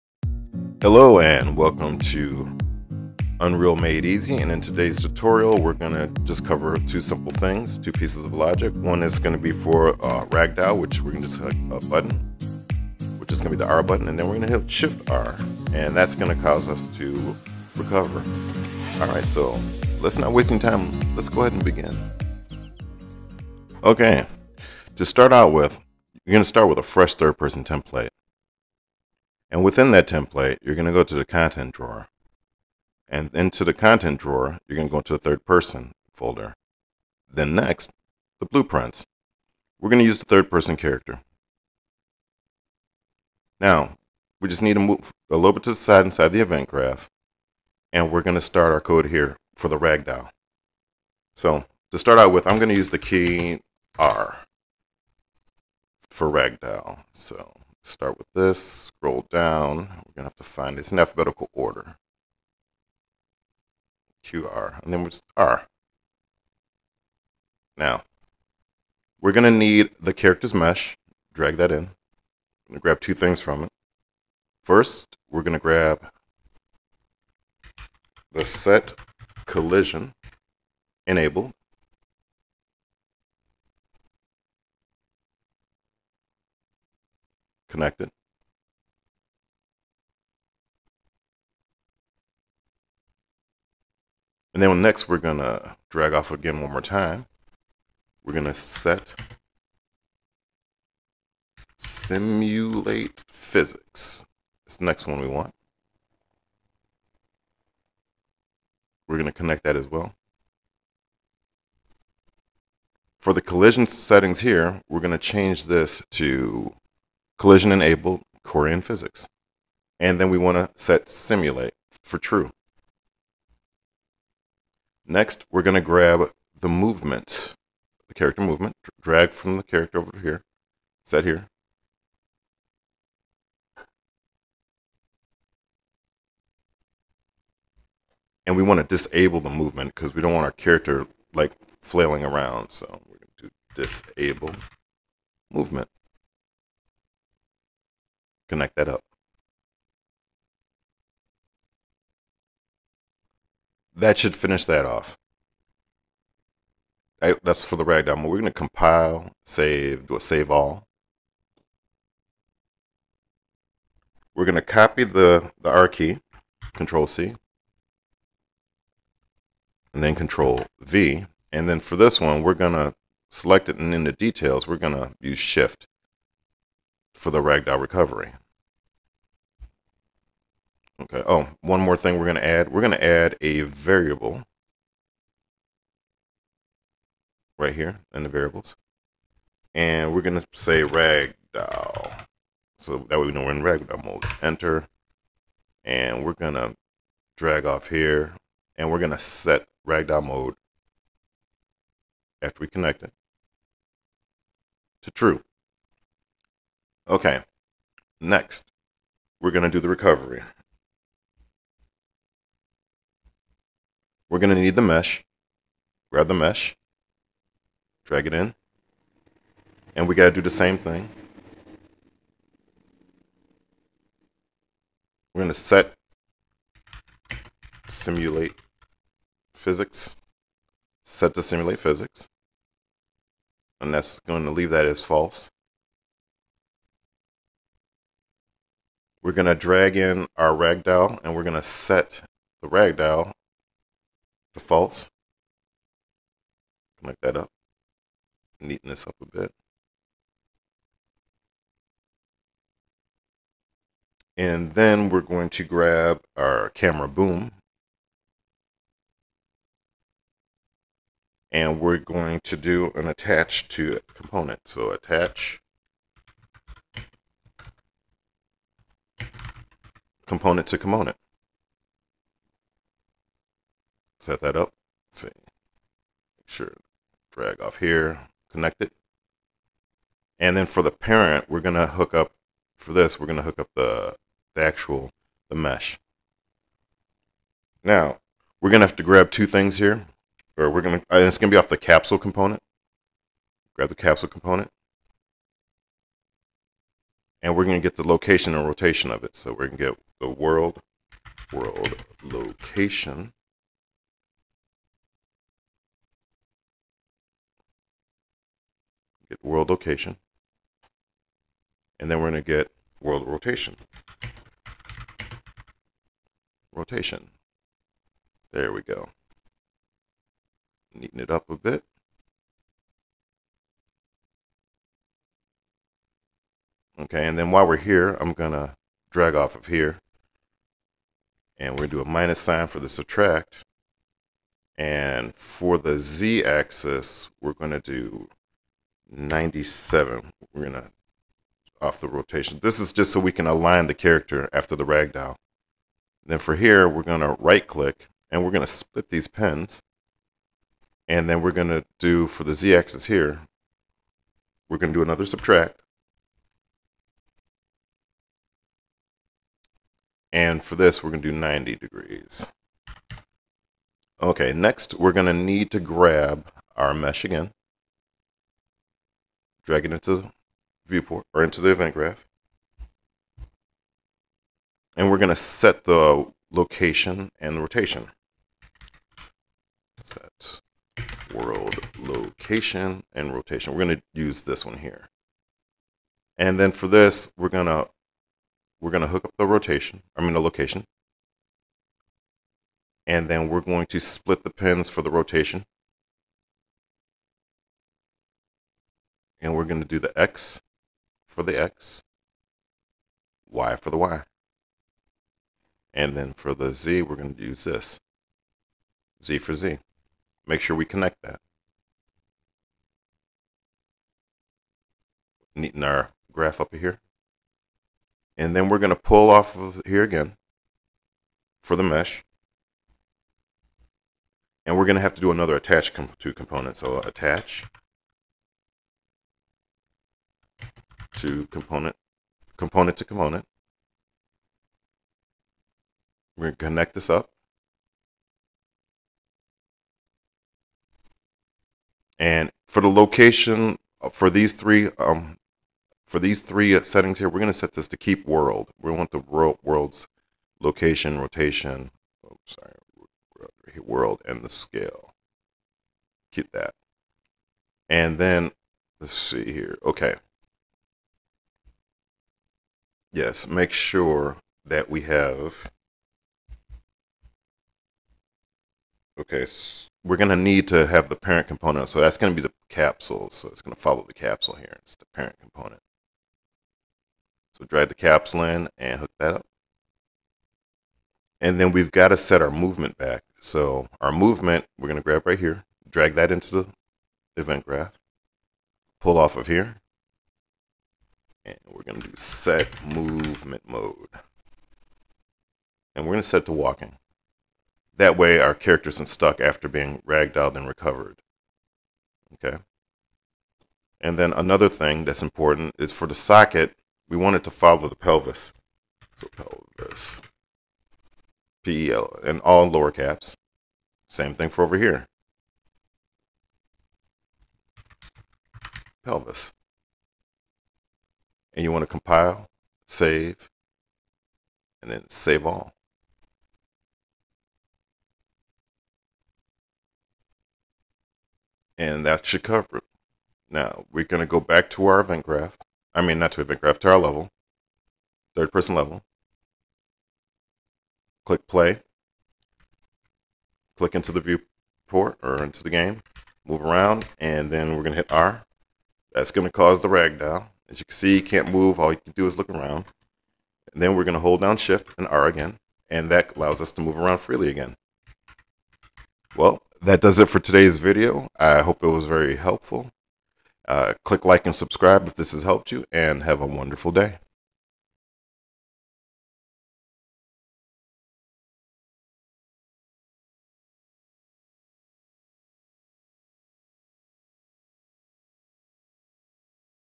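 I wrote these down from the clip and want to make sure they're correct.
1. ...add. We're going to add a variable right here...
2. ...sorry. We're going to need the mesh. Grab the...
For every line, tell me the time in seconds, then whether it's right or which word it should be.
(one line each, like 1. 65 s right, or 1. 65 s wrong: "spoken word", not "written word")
1. 182 s right
2. 209 s wrong: "recovery", not "sorry".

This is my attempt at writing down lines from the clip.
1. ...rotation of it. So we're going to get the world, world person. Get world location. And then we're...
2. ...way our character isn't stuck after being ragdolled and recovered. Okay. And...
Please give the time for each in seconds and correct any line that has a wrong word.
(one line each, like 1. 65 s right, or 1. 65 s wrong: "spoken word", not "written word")
1. 298 s wrong: "location", not "person"
2. 498 s right.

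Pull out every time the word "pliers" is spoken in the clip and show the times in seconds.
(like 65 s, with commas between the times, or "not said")
not said.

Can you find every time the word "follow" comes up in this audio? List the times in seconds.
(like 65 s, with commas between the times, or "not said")
473 s, 507 s.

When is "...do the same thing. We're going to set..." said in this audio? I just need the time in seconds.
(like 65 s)
220 s.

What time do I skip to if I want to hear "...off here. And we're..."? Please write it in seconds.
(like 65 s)
197 s.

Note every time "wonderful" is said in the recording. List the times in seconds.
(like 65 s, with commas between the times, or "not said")
566 s.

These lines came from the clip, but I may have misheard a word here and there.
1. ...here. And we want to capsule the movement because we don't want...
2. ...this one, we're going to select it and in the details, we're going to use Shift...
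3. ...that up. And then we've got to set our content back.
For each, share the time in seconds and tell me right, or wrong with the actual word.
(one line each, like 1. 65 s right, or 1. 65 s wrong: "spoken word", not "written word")
1. 131 s wrong: "disable", not "capsule"
2. 171 s right
3. 479 s wrong: "movement", not "content".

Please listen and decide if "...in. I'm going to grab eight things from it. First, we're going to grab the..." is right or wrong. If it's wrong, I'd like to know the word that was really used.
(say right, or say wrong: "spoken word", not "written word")
wrong: "two", not "eight".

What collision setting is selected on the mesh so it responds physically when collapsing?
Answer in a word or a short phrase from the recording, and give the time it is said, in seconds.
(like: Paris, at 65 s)
Query and physics, at 117 s.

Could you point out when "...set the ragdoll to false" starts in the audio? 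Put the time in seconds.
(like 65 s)
241 s.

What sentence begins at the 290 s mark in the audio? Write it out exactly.
Or we're going to, and it's going to be off the capsule component.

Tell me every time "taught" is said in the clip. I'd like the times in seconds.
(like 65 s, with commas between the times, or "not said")
not said.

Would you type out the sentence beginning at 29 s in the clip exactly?
And within that template, you're going to go to the content drawer.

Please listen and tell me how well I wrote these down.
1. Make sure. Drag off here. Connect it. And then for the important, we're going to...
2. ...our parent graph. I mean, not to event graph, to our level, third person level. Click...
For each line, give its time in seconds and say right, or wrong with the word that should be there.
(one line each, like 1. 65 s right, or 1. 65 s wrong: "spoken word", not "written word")
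1. 276 s wrong: "parent", not "important"
2. 534 s wrong: "event", not "parent".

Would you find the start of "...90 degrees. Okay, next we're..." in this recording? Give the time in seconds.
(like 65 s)
361 s.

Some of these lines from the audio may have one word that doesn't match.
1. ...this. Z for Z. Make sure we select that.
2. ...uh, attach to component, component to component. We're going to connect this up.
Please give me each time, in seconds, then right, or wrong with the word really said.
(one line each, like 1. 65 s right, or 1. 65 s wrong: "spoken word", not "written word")
1. 407 s wrong: "connect", not "select"
2. 426 s right.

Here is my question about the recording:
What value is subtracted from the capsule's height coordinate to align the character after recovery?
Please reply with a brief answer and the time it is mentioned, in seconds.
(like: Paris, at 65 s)
97, at 339 s.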